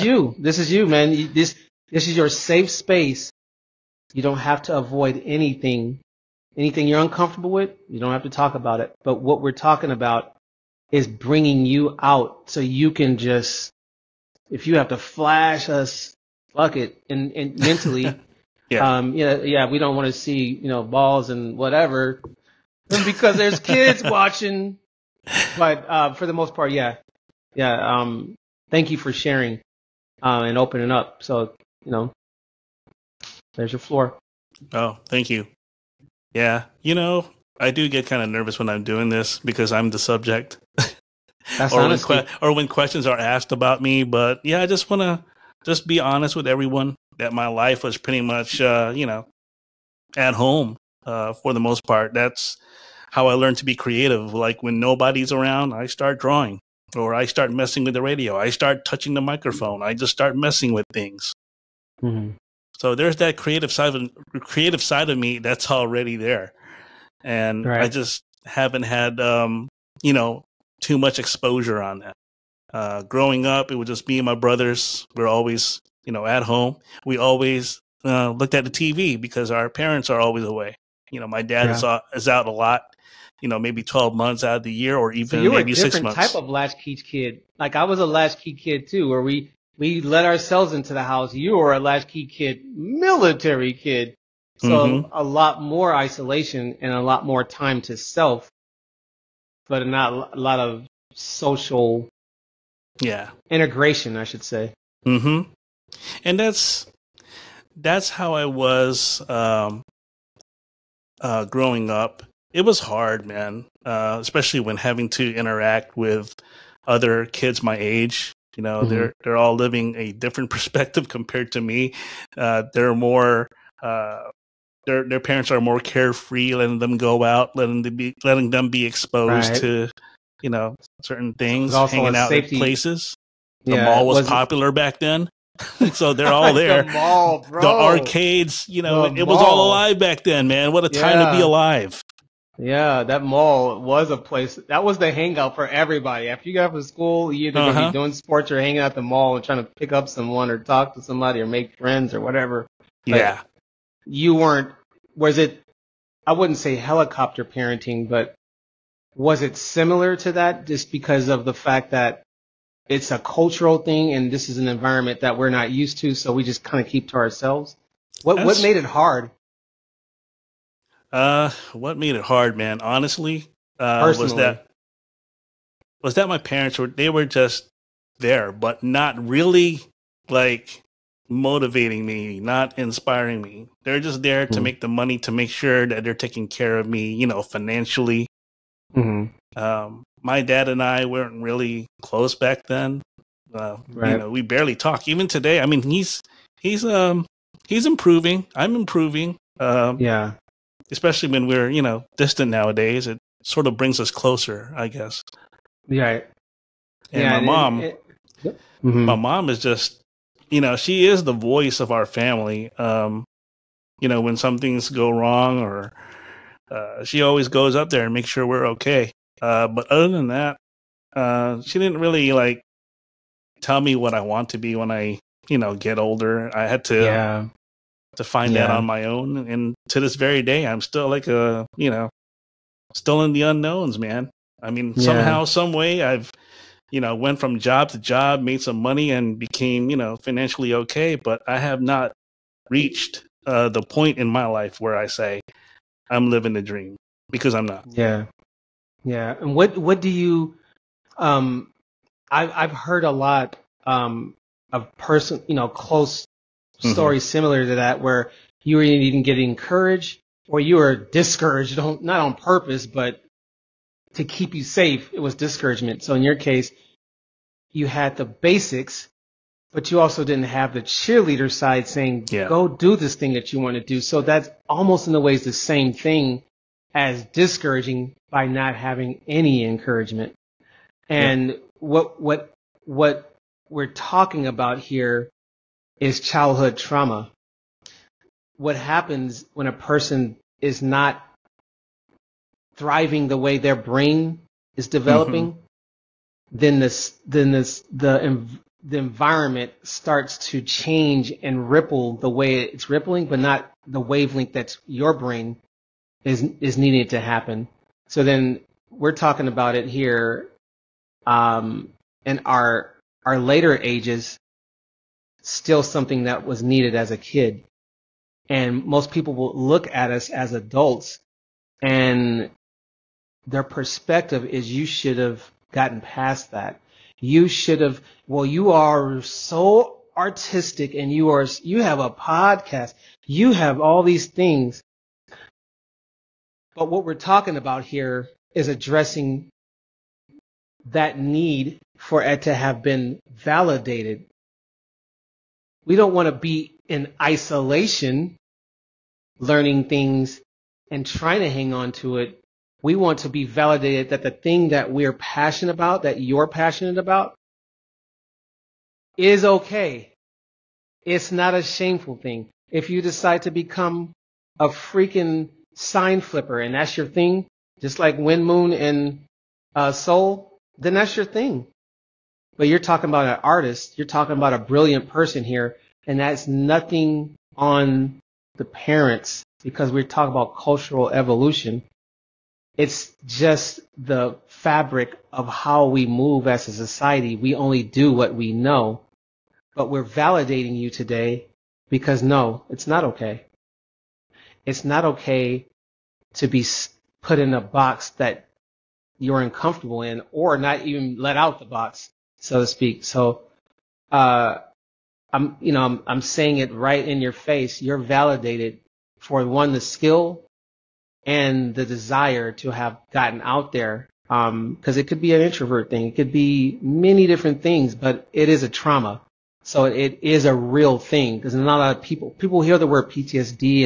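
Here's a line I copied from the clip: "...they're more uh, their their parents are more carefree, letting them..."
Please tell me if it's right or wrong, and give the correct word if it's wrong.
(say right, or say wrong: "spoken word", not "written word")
right.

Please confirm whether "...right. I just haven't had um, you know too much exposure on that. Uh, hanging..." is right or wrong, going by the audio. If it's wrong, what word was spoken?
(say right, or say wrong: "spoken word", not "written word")
wrong: "growing", not "hanging".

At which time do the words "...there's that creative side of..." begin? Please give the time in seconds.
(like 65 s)
62 s.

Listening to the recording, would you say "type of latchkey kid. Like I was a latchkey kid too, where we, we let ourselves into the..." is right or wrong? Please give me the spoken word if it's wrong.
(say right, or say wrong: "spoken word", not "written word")
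right.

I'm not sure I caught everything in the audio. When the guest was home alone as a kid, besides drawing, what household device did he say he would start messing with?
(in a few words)
The radio.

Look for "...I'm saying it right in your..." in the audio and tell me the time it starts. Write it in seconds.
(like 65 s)
406 s.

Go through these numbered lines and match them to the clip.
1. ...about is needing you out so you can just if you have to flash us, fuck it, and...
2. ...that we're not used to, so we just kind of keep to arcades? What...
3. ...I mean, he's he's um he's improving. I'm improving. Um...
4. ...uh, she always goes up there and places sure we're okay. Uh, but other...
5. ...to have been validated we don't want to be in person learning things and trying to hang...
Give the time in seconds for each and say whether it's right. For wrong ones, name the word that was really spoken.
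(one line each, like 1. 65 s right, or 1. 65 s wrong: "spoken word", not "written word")
1. 9 s wrong: "bringing", not "needing"
2. 165 s wrong: "ourselves", not "arcades"
3. 195 s right
4. 216 s wrong: "makes", not "places"
5. 342 s wrong: "isolation", not "person".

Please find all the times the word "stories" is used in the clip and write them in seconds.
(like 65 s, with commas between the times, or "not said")
256 s.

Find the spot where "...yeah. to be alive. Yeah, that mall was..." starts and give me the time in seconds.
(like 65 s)
141 s.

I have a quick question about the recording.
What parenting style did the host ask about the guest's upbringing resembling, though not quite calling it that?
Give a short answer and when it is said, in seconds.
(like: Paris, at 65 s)
Helicopter parenting, at 156 s.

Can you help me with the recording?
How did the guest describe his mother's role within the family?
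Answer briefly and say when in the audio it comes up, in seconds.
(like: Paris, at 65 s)
The voice of our family, at 211 s.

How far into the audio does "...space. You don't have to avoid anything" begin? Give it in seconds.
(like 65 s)
2 s.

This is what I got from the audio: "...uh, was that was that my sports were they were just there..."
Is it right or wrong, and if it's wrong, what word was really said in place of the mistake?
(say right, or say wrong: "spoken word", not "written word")
wrong: "parents", not "sports".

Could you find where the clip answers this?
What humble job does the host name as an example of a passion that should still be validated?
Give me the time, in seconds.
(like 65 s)
365 s.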